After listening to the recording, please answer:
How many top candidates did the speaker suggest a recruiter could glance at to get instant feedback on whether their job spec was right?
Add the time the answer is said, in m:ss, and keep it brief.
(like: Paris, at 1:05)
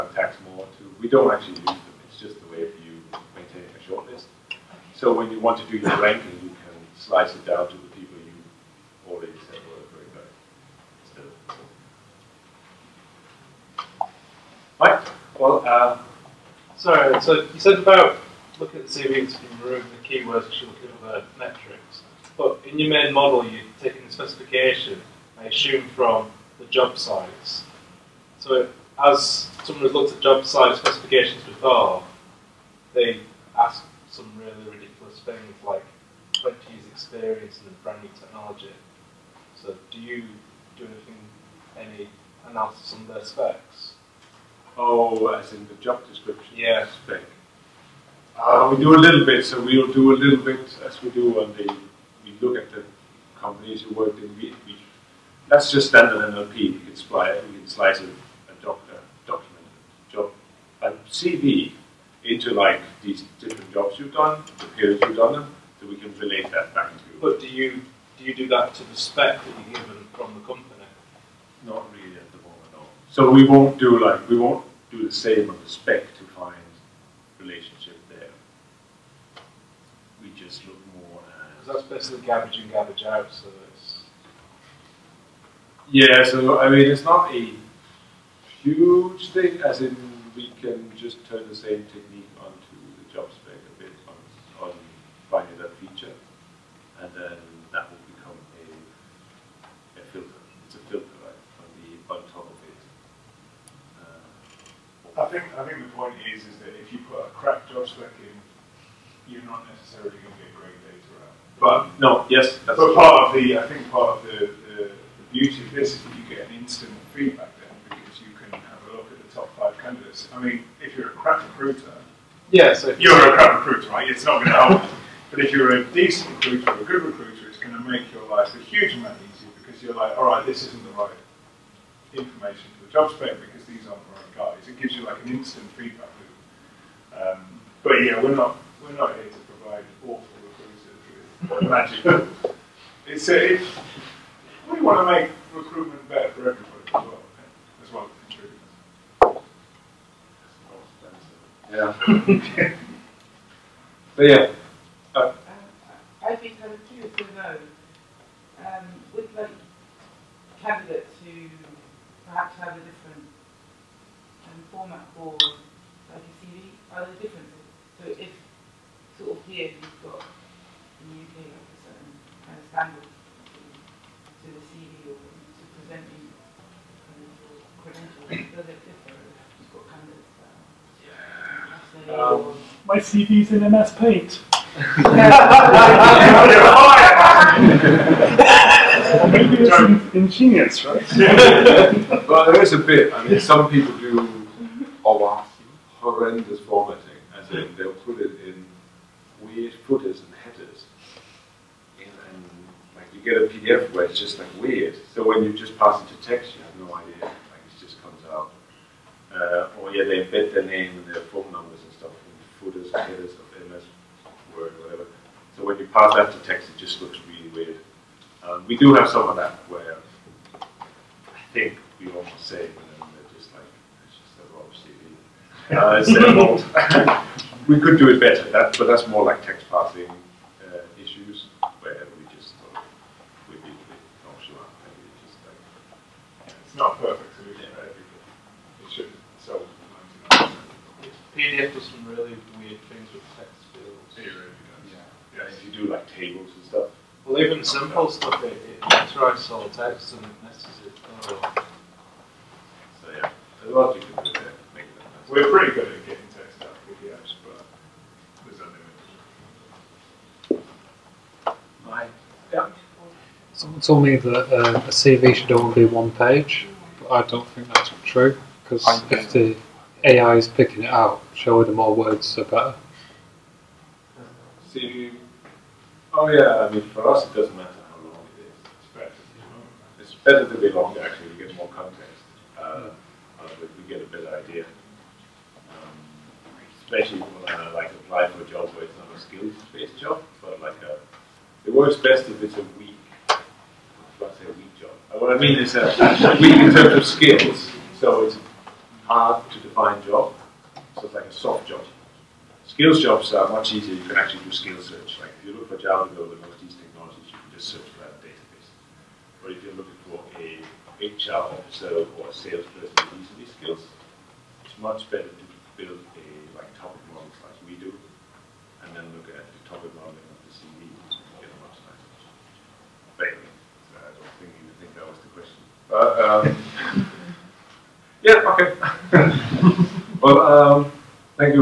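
5, at 1:59.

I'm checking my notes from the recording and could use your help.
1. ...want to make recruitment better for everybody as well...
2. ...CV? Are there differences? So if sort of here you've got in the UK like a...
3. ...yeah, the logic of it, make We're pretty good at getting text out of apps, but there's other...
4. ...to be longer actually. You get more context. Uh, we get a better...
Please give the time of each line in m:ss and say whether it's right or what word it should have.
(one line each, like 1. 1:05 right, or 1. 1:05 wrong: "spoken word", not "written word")
1. 2:24 right
2. 2:46 right
3. 4:13 right
4. 4:40 right.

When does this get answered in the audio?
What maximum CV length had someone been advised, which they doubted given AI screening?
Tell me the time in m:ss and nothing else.
4:25.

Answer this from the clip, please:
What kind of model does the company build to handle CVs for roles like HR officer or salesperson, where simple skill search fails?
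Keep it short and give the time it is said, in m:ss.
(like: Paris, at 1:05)
topic model, at 5:16.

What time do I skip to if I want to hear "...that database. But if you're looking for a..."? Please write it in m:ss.
5:08.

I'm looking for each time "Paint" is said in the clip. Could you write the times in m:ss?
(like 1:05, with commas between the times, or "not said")
3:03.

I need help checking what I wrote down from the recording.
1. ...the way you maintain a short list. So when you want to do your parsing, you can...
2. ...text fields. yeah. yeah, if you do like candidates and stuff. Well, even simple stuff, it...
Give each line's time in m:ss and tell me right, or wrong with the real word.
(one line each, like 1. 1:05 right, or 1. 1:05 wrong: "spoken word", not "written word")
1. 0:02 wrong: "ranking", not "parsing"
2. 4:03 wrong: "tables", not "candidates".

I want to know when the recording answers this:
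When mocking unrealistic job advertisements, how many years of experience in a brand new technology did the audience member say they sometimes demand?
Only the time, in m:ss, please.
0:36.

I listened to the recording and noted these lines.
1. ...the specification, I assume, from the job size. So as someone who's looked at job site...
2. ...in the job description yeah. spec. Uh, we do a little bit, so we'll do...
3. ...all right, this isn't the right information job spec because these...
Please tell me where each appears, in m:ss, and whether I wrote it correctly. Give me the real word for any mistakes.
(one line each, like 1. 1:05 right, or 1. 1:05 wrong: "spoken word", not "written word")
1. 0:24 right
2. 0:45 right
3. 2:10 right.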